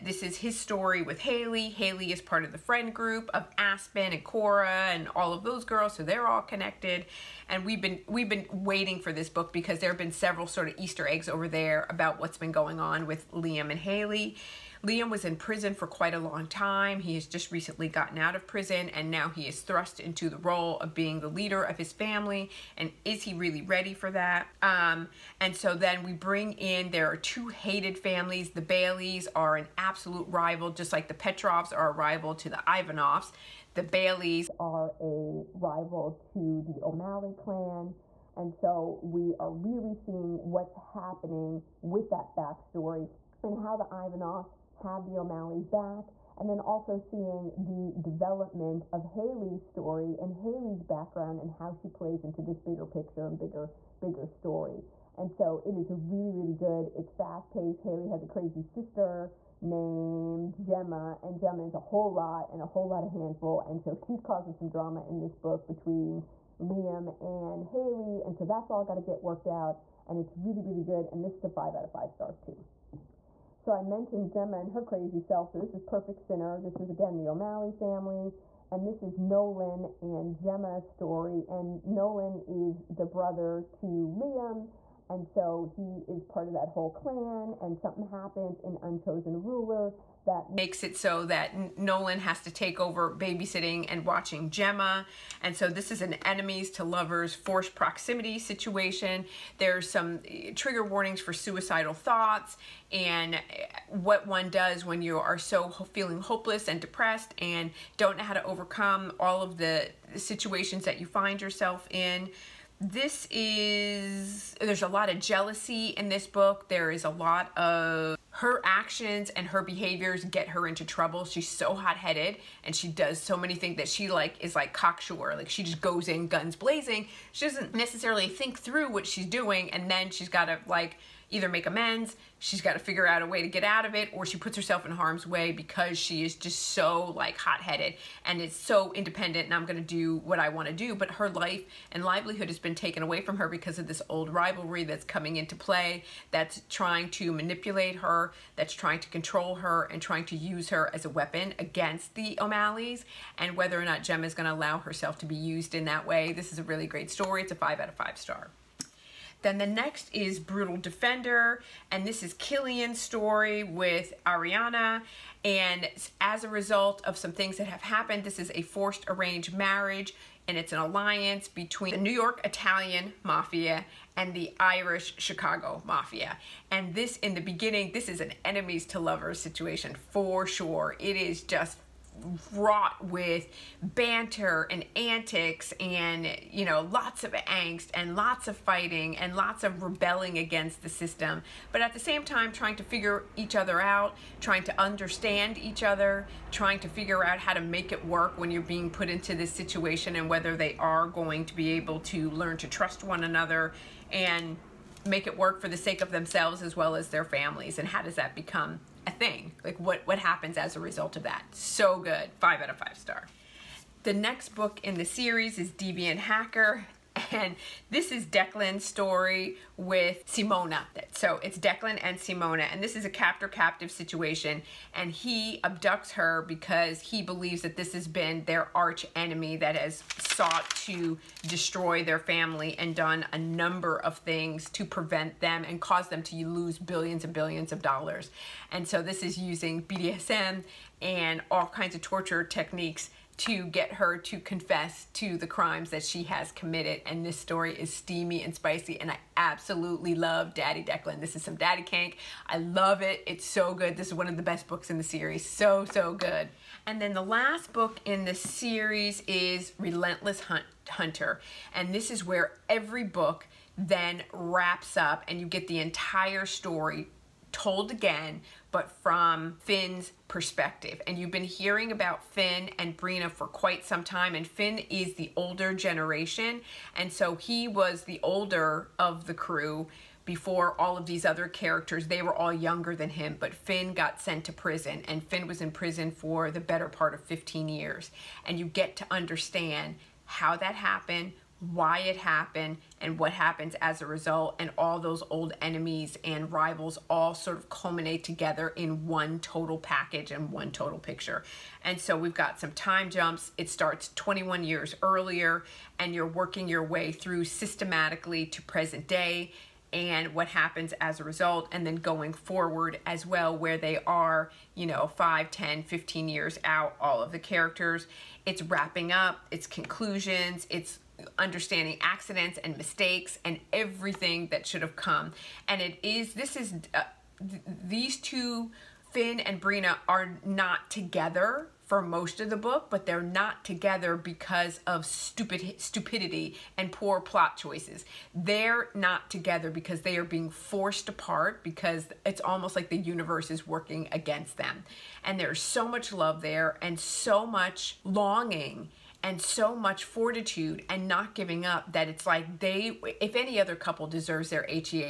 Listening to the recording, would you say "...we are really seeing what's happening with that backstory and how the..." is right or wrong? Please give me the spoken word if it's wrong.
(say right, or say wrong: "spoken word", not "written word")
right.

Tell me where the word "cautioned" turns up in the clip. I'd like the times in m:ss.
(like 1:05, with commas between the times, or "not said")
not said.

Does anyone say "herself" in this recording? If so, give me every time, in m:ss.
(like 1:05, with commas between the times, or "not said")
2:14, 2:34.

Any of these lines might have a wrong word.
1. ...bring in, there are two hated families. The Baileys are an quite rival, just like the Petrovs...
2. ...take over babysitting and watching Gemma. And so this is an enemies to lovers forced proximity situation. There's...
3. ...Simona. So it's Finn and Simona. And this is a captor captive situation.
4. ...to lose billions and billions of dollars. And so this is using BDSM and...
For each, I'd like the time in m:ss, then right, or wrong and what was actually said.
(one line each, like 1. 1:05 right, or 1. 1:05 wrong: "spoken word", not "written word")
1. 0:26 wrong: "absolute", not "quite"
2. 1:32 right
3. 3:40 wrong: "Declan", not "Finn"
4. 3:56 right.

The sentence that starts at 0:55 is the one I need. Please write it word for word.
And so it is really, really good.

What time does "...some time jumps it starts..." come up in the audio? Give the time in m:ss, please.
5:02.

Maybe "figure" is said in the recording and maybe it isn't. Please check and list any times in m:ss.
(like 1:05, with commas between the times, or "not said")
2:12, 3:12, 3:16.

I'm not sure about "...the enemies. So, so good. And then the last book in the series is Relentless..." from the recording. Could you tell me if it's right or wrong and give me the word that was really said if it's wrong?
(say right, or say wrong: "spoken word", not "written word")
wrong: "series", not "enemies".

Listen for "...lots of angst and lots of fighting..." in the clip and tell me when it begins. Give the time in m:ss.
3:06.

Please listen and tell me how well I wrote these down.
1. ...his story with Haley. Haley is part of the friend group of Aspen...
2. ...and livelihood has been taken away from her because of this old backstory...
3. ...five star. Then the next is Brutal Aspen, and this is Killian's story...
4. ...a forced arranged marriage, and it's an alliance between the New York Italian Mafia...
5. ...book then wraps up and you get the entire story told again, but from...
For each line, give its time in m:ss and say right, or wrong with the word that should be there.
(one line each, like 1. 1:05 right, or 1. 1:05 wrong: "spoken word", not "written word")
1. 0:00 right
2. 2:21 wrong: "rivalry", not "backstory"
3. 2:37 wrong: "Defender", not "Aspen"
4. 2:48 right
5. 4:23 right.